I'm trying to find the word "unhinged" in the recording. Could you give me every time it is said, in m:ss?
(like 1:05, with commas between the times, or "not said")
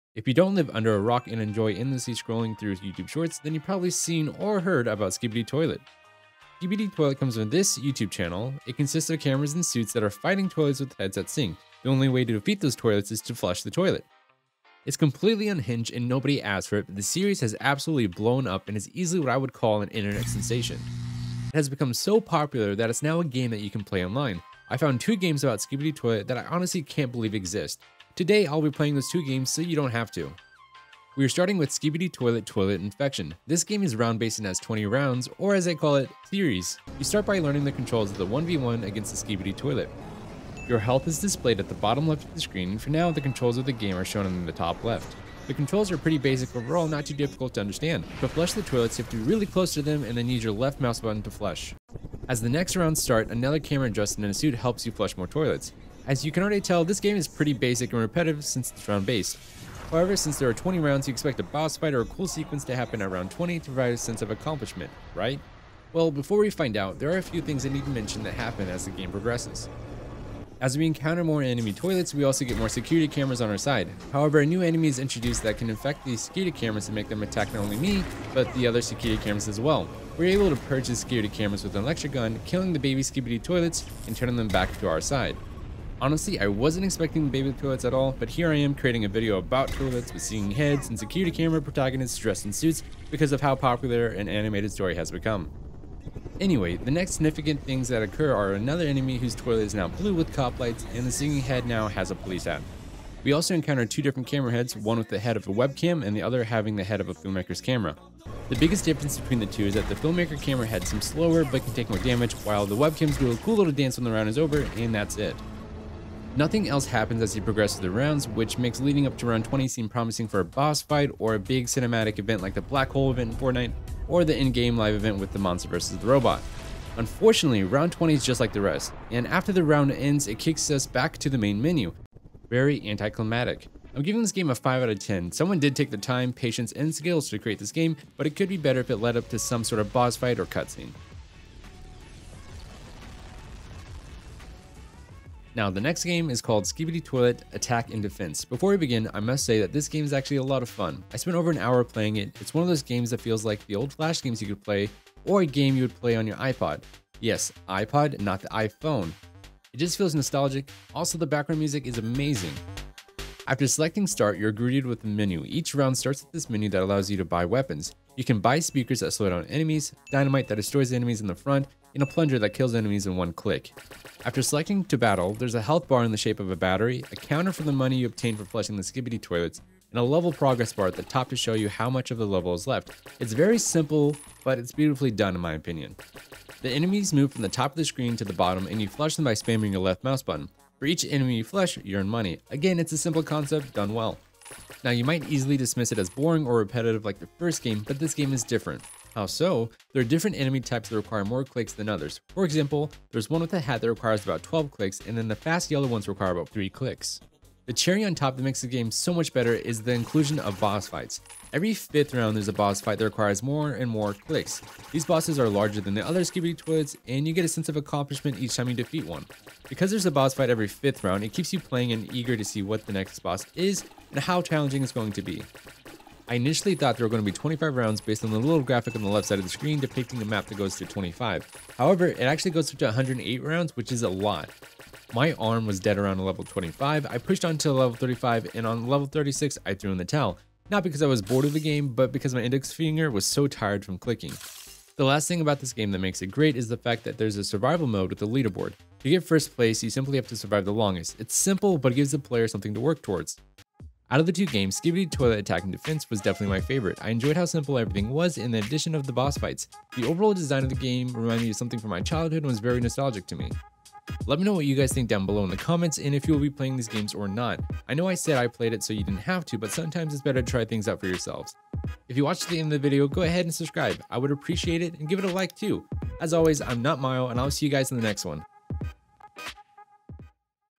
0:15.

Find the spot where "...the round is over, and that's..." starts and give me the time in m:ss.
1:54.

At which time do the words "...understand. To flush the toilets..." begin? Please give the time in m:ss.
0:47.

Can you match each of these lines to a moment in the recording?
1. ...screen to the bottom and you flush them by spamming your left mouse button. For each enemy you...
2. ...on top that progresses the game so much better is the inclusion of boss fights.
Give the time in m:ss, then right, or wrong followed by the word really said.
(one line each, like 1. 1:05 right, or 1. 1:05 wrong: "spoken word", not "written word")
1. 3:07 right
2. 3:28 wrong: "makes", not "progresses".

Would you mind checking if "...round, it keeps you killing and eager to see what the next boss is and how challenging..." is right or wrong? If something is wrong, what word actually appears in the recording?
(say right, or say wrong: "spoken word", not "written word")
wrong: "playing", not "killing".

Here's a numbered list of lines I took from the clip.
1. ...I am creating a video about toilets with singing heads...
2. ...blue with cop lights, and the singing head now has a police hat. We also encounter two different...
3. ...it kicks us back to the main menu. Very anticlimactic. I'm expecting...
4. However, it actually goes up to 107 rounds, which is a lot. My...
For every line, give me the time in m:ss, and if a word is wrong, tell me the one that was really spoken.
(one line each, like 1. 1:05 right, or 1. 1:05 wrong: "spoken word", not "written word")
1. 1:28 right
2. 1:39 right
3. 2:10 wrong: "giving", not "expecting"
4. 3:51 wrong: "108", not "107".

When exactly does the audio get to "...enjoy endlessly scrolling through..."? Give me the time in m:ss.
0:01.